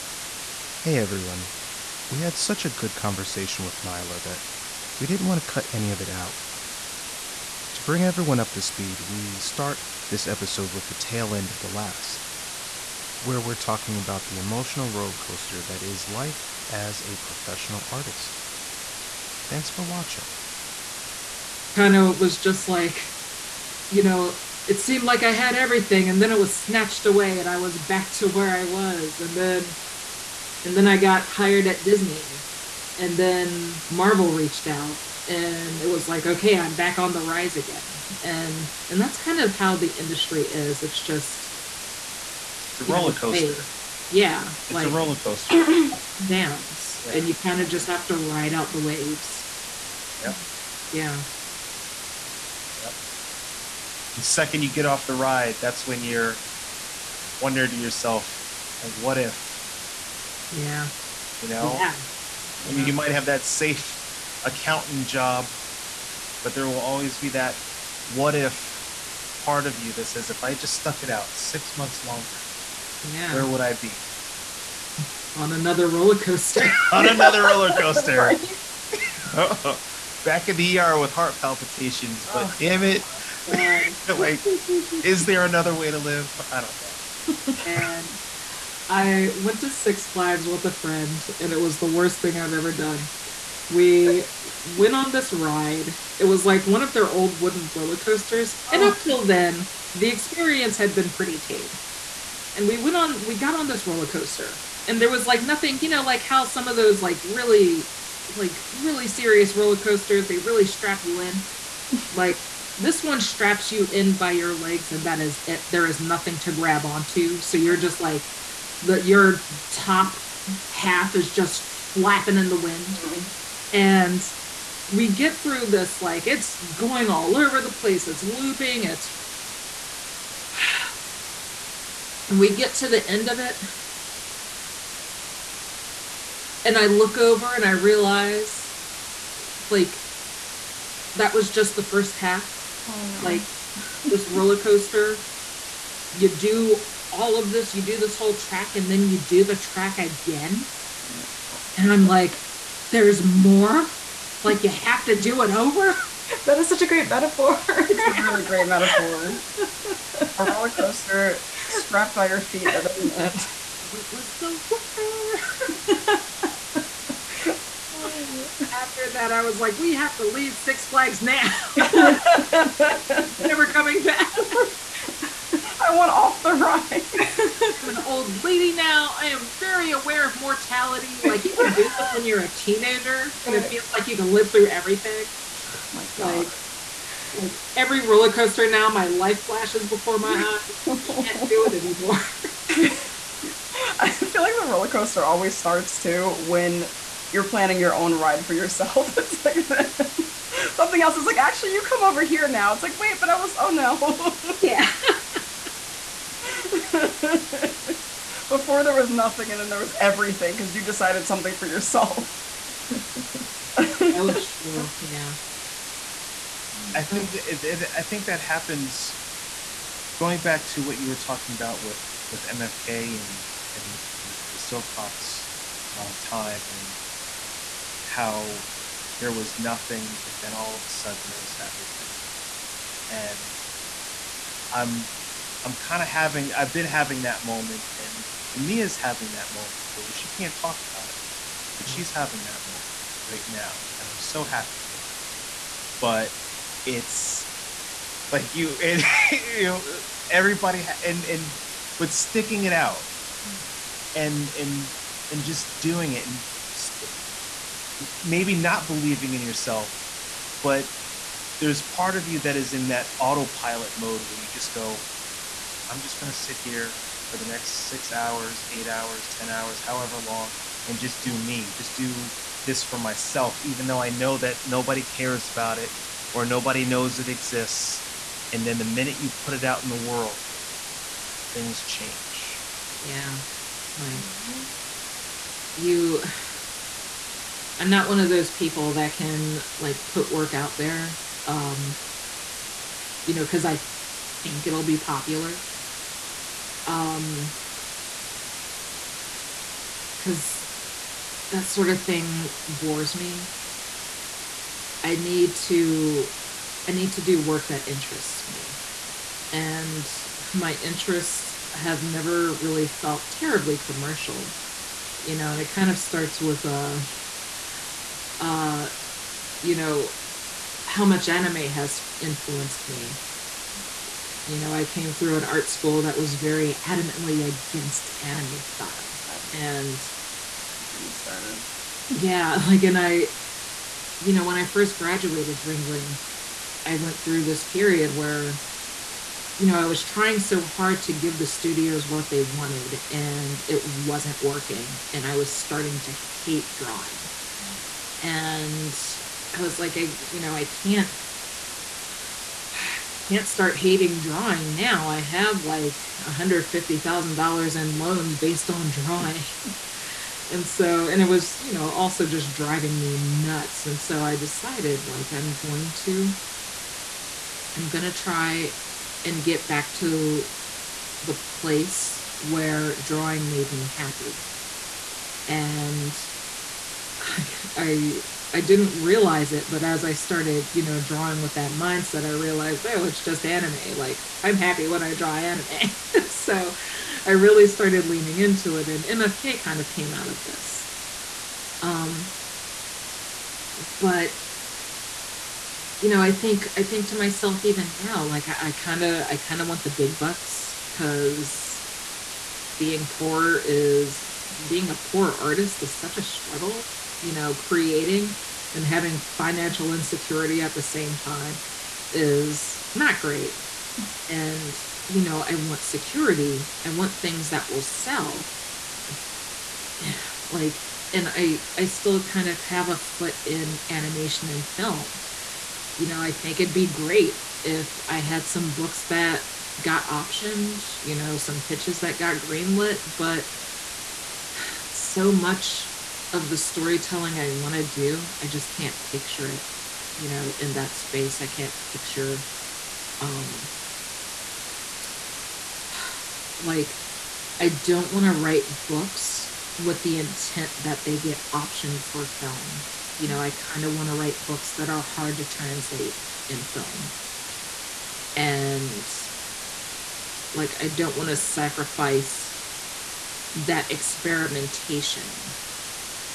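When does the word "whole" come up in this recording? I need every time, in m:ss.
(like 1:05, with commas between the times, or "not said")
2:28.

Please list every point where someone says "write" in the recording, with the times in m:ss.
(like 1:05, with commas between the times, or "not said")
7:28, 7:34.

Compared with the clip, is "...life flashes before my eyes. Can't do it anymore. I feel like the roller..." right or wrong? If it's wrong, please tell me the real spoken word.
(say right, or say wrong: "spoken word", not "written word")
right.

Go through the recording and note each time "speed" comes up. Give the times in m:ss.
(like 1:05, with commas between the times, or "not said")
0:08.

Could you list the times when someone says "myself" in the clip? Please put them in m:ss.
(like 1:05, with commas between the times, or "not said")
4:32, 6:37.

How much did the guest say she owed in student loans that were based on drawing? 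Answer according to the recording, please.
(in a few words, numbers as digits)
$150,000.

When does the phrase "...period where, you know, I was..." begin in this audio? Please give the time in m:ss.
5:37.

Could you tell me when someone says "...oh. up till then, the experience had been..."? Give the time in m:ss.
1:38.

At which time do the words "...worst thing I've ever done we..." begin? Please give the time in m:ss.
1:31.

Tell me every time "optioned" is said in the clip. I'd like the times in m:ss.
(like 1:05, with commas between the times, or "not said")
7:10, 7:31.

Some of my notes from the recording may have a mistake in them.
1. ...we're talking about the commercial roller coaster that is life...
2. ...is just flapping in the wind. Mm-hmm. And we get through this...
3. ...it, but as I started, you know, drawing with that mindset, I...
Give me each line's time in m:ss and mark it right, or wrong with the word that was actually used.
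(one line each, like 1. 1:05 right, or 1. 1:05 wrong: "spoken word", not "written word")
1. 0:13 wrong: "emotional", not "commercial"
2. 2:01 right
3. 6:19 right.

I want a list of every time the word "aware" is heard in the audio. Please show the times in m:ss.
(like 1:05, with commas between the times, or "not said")
2:59.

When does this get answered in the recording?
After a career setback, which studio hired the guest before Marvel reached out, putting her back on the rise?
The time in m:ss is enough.
0:31.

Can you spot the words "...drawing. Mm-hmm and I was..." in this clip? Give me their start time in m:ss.
5:46.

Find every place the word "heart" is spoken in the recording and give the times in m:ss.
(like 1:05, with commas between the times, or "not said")
1:21.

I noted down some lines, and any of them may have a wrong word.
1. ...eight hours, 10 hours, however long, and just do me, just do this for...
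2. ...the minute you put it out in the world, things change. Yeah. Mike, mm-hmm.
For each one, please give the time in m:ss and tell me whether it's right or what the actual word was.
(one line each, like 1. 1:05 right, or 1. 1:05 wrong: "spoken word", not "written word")
1. 4:28 right
2. 4:38 right.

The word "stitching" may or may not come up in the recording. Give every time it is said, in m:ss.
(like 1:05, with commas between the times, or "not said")
not said.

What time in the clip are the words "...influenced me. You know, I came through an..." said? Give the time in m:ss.
5:22.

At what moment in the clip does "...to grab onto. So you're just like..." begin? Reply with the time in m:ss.
1:56.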